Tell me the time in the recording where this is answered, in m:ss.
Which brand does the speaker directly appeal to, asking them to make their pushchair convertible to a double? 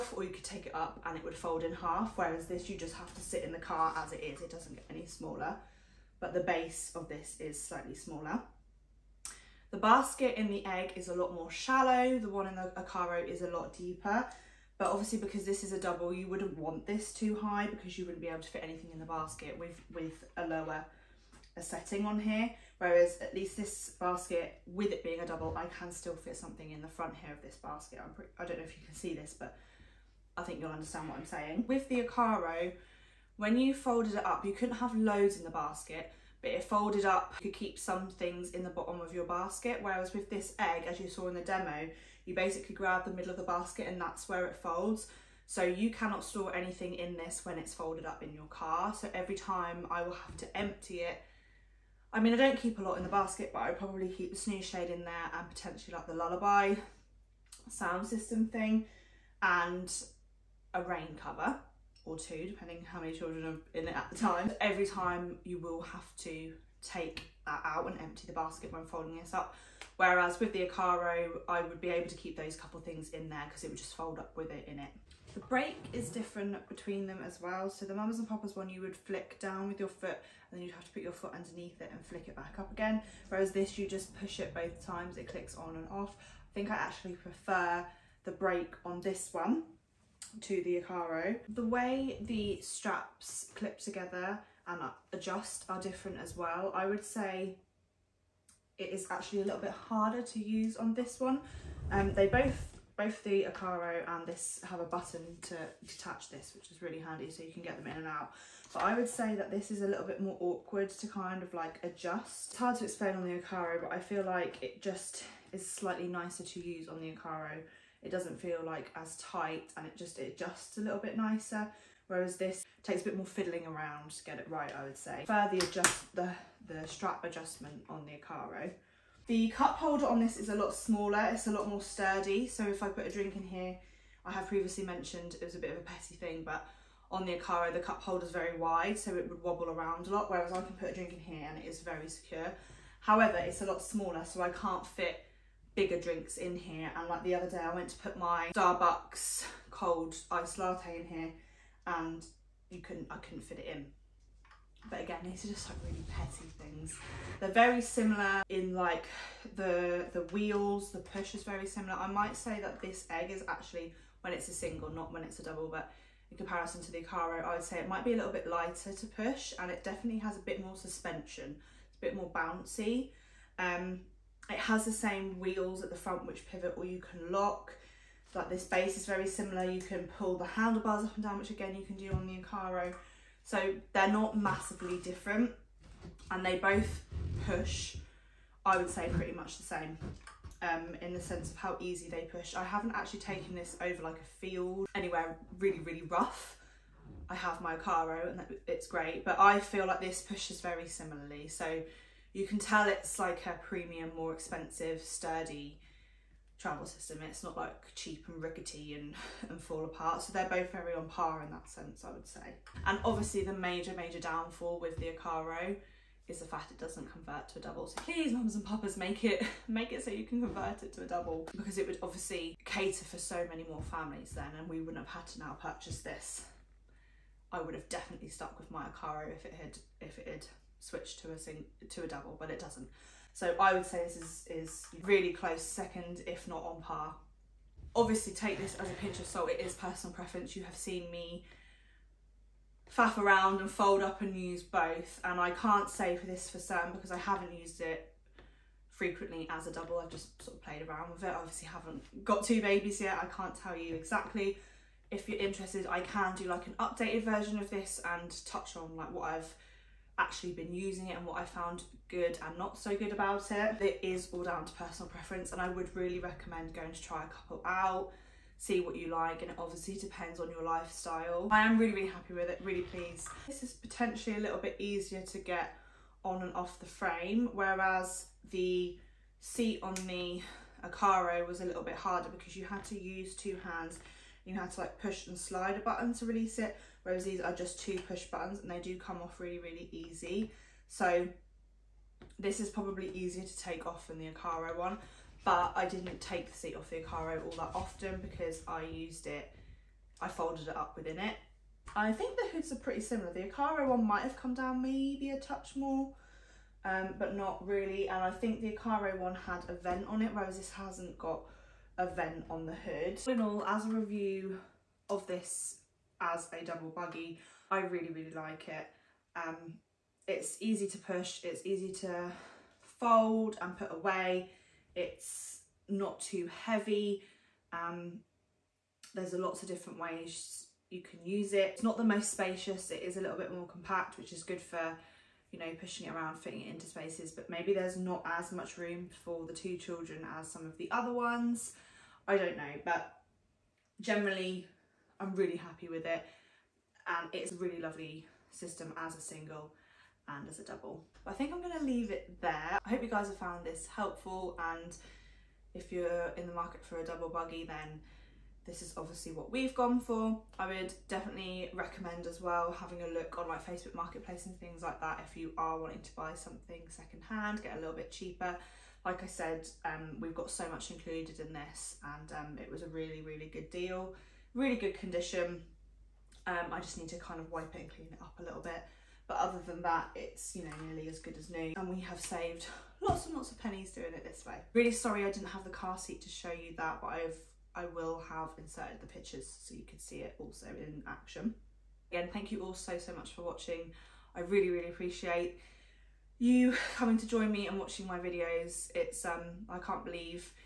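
3:38.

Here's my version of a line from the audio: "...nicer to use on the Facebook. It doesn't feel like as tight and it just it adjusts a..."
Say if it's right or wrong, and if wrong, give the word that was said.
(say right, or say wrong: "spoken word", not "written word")
wrong: "Ocarro", not "Facebook".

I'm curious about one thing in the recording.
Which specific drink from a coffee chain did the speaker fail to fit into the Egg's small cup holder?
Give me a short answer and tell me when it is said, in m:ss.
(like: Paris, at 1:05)
Starbucks cold iced latte, at 2:28.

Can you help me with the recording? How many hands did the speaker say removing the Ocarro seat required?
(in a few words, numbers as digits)
2.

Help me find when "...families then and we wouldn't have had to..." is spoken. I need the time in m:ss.
3:43.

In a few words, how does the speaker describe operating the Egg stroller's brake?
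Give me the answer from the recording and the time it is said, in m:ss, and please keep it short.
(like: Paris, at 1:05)
push it both times, at 1:24.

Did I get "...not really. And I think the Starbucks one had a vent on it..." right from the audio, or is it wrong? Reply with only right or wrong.
wrong.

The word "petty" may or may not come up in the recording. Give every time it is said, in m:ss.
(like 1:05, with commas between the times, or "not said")
2:15, 2:36.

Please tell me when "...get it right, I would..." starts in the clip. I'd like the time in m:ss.
2:04.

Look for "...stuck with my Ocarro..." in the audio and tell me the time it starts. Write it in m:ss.
3:48.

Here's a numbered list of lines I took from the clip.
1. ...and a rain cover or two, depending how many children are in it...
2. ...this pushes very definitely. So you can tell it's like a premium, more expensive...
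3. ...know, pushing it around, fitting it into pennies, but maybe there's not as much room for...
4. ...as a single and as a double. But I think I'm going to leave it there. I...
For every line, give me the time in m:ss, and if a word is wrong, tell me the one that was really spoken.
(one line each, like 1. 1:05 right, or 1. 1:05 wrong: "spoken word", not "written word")
1. 0:59 right
2. 3:20 wrong: "similarly", not "definitely"
3. 5:35 wrong: "spaces", not "pennies"
4. 5:48 right.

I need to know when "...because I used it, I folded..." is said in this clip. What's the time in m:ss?
4:58.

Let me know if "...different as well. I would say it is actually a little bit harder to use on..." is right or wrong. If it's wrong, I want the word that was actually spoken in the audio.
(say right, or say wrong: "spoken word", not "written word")
right.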